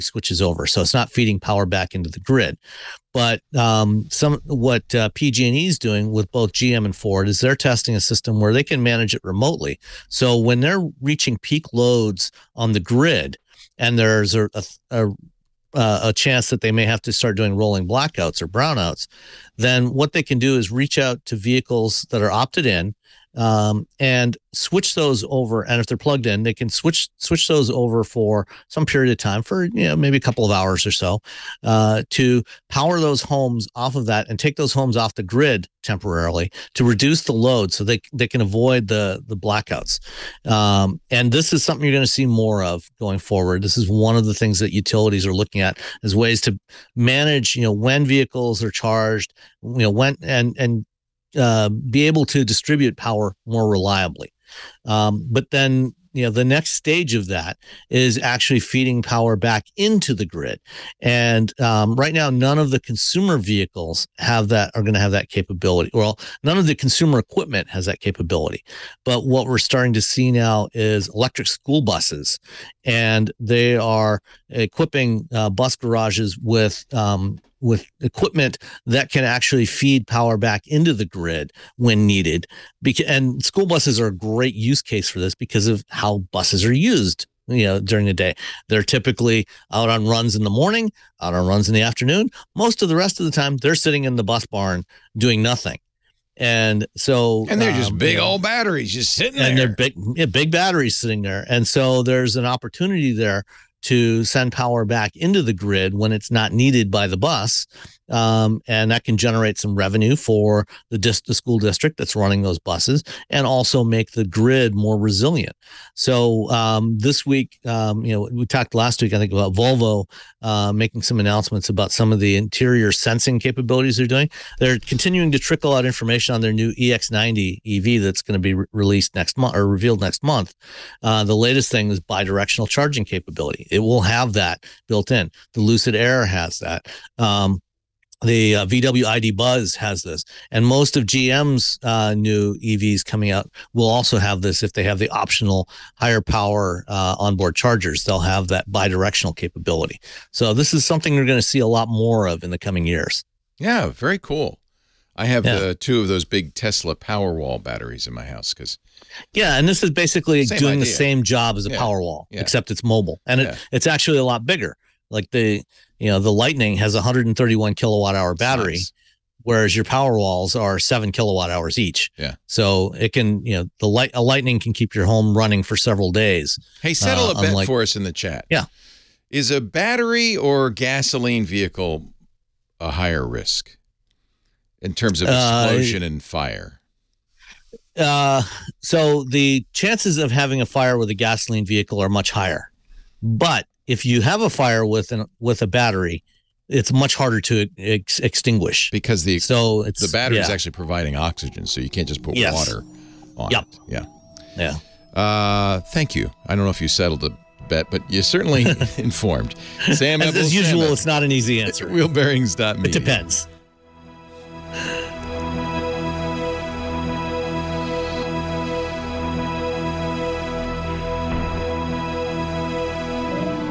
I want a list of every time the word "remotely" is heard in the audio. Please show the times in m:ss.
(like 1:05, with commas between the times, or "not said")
0:09.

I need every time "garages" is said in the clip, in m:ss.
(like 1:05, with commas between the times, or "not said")
1:15.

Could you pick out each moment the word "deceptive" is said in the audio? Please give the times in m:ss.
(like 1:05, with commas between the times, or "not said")
not said.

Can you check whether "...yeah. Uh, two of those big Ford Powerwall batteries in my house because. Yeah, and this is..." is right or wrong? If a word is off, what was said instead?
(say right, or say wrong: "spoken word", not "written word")
wrong: "Tesla", not "Ford".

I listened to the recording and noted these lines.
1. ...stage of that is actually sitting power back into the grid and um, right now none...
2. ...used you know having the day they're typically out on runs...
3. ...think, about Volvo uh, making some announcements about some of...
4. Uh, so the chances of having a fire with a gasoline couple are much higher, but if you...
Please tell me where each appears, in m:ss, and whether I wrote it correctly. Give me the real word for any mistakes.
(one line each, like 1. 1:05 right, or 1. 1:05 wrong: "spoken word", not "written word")
1. 0:56 wrong: "feeding", not "sitting"
2. 1:26 wrong: "during", not "having"
3. 1:59 right
4. 3:07 wrong: "vehicle", not "couple".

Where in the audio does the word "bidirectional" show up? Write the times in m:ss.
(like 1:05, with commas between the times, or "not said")
2:12, 2:28.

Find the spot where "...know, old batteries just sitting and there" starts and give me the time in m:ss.
1:38.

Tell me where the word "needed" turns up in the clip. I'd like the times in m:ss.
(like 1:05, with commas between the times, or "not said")
1:22, 1:46.